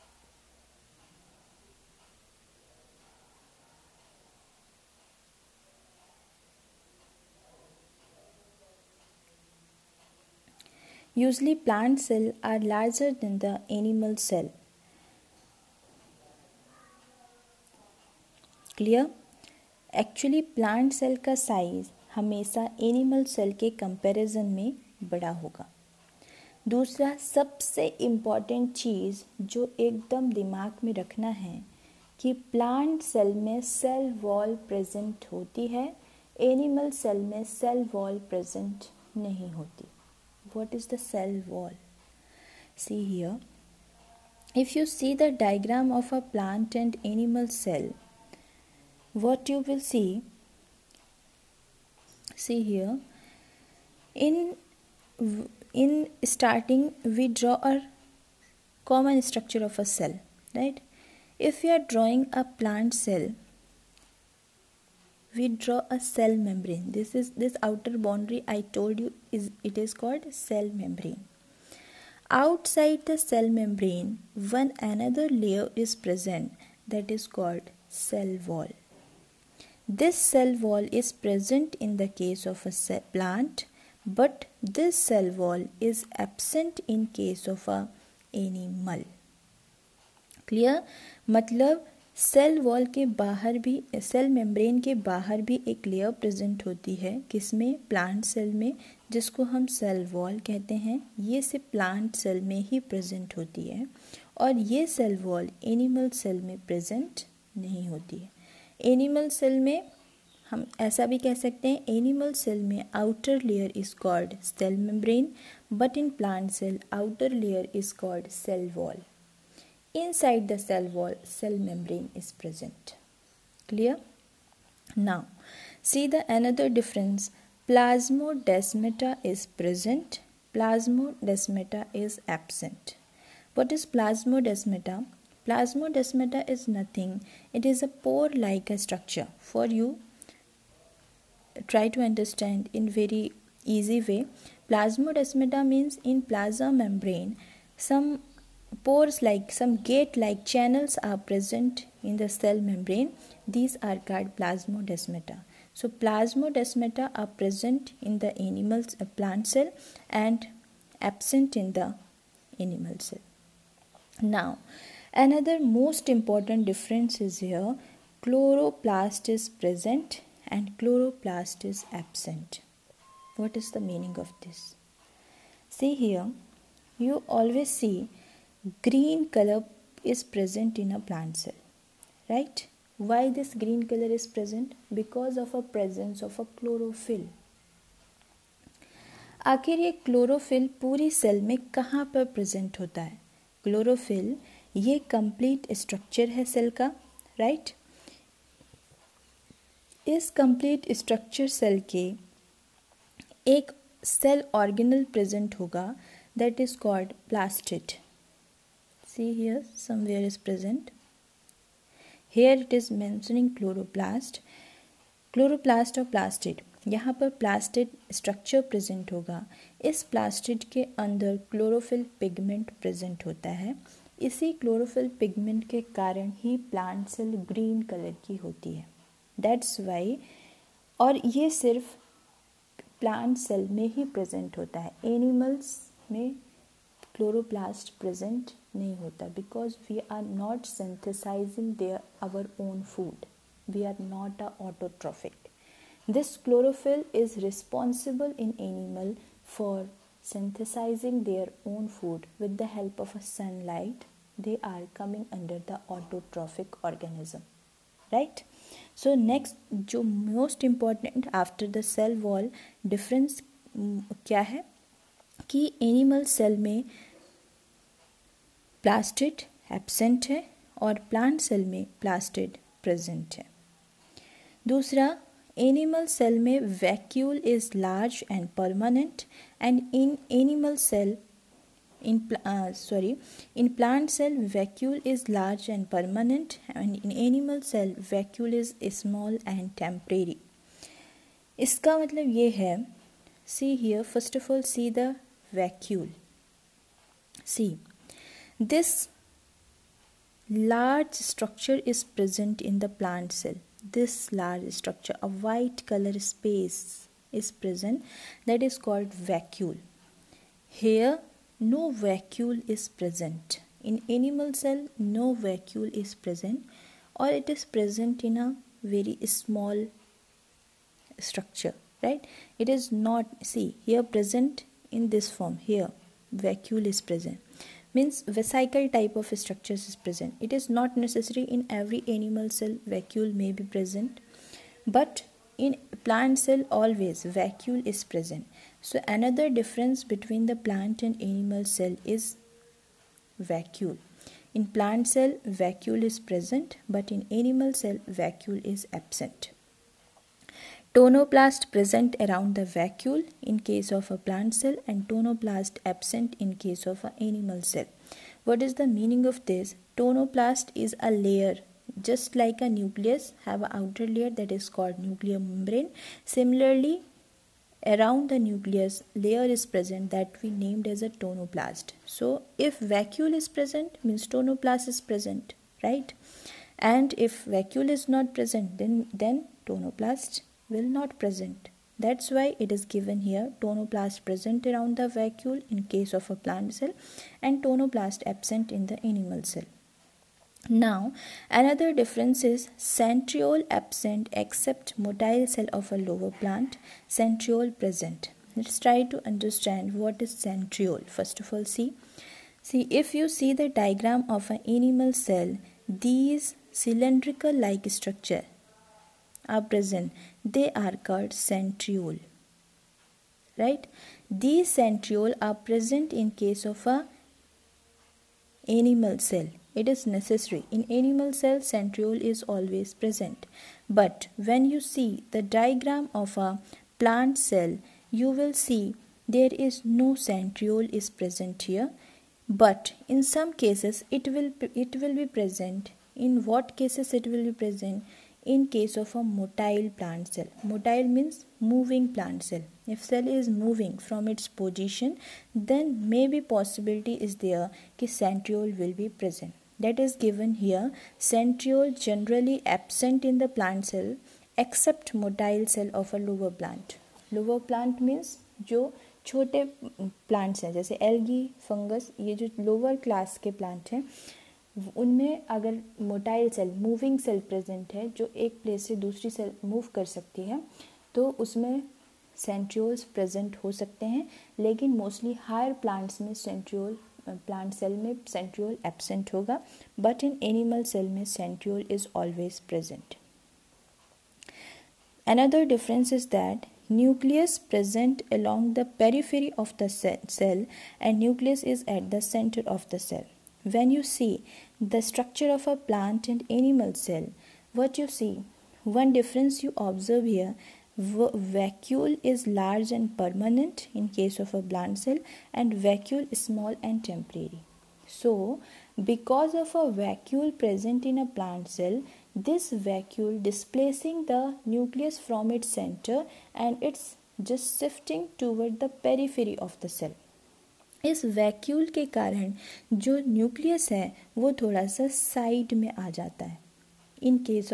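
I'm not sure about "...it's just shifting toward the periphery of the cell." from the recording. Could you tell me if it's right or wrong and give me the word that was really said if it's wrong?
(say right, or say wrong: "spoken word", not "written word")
right.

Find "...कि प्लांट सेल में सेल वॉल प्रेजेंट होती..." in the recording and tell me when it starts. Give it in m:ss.
0:32.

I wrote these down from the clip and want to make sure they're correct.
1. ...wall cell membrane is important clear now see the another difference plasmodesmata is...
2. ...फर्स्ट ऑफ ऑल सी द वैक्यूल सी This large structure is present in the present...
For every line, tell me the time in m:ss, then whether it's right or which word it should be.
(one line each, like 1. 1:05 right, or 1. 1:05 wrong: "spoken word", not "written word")
1. 2:00 wrong: "present", not "important"
2. 4:54 wrong: "plant", not "present".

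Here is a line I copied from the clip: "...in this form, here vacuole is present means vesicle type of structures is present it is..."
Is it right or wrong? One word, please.
right.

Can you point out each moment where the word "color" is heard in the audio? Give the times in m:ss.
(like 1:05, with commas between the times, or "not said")
2:59, 3:03, 5:05.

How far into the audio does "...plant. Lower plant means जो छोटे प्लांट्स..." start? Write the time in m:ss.
7:36.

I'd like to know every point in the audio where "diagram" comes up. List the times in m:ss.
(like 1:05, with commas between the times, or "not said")
0:45, 6:43, 7:05.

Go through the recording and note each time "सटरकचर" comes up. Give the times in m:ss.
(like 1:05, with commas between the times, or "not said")
3:15, 3:20, 3:38.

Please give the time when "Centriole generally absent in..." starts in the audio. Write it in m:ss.
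7:31.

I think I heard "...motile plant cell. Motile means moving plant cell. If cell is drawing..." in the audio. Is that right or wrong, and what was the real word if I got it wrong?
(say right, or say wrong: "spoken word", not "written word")
wrong: "moving", not "drawing".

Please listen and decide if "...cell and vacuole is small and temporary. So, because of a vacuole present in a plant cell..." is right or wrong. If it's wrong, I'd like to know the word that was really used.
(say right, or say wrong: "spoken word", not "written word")
right.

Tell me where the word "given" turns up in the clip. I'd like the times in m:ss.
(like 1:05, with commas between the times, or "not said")
6:22, 7:30.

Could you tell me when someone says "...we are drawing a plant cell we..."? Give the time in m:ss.
1:01.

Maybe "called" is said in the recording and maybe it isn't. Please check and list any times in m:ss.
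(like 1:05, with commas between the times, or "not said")
1:09, 1:17, 2:34, 5:08, 6:04, 6:51.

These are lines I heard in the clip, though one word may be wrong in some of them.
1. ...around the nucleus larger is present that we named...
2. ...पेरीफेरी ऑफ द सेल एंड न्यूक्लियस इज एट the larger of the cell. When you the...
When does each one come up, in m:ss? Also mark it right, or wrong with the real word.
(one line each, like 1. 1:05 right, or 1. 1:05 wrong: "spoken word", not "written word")
1. 6:07 wrong: "layer", not "larger"
2. 8:08 wrong: "center", not "larger".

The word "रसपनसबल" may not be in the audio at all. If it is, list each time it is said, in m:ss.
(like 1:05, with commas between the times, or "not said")
4:07.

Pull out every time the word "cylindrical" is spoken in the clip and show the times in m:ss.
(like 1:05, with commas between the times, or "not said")
6:46.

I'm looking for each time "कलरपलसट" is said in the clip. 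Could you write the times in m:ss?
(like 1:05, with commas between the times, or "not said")
3:35, 3:57.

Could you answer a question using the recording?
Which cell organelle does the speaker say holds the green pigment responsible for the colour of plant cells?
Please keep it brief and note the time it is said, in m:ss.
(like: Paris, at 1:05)
plastid, at 3:26.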